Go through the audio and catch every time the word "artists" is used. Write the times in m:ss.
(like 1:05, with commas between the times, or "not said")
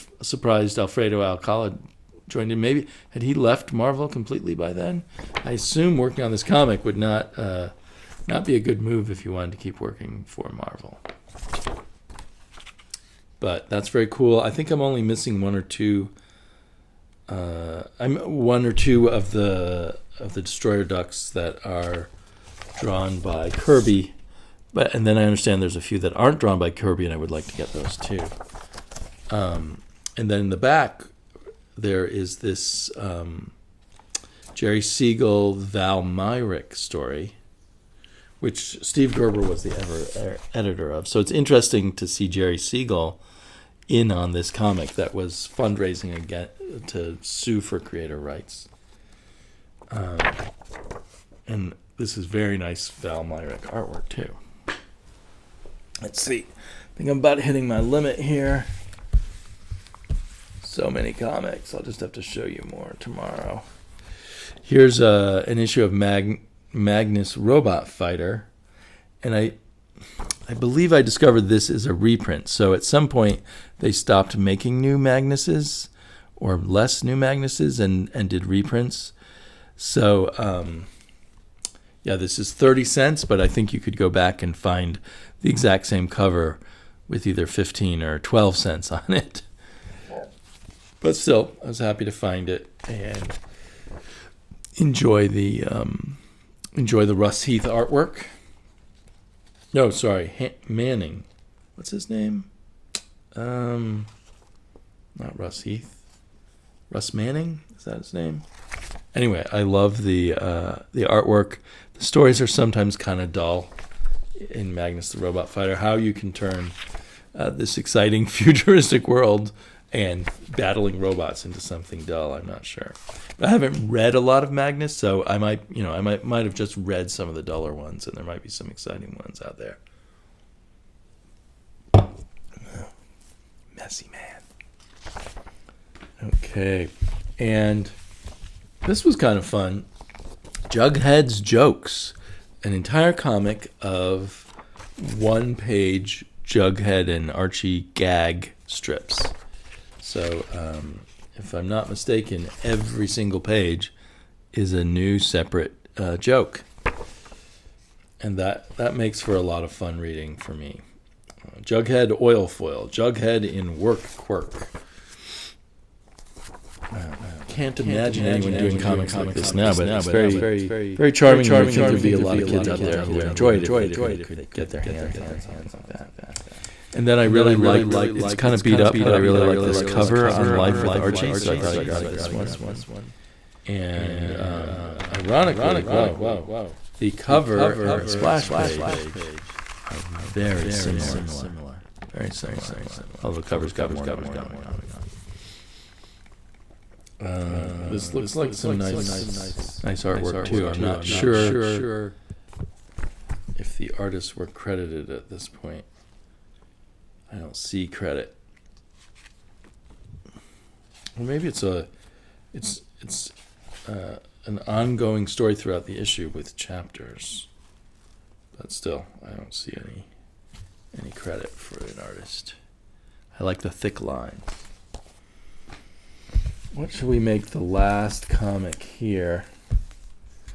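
3:23, 3:41.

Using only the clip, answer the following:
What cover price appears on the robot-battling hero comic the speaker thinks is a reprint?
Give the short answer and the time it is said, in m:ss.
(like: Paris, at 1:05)
30 cents, at 1:22.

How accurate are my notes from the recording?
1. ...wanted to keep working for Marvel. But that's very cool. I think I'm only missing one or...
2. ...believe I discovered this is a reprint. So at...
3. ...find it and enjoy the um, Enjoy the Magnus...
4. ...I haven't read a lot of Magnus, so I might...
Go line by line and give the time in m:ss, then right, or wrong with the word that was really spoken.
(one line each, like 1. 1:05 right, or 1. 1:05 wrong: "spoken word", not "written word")
1. 0:09 right
2. 1:10 right
3. 1:32 wrong: "Russ", not "Magnus"
4. 2:03 right.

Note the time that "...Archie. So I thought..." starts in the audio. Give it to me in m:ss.
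3:00.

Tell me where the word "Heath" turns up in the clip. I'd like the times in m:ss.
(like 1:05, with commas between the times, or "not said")
1:37, 1:45.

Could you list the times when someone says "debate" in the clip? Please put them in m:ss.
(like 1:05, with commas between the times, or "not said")
not said.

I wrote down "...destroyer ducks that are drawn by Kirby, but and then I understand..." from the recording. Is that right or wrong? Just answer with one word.
right.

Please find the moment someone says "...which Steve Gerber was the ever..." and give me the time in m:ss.
0:38.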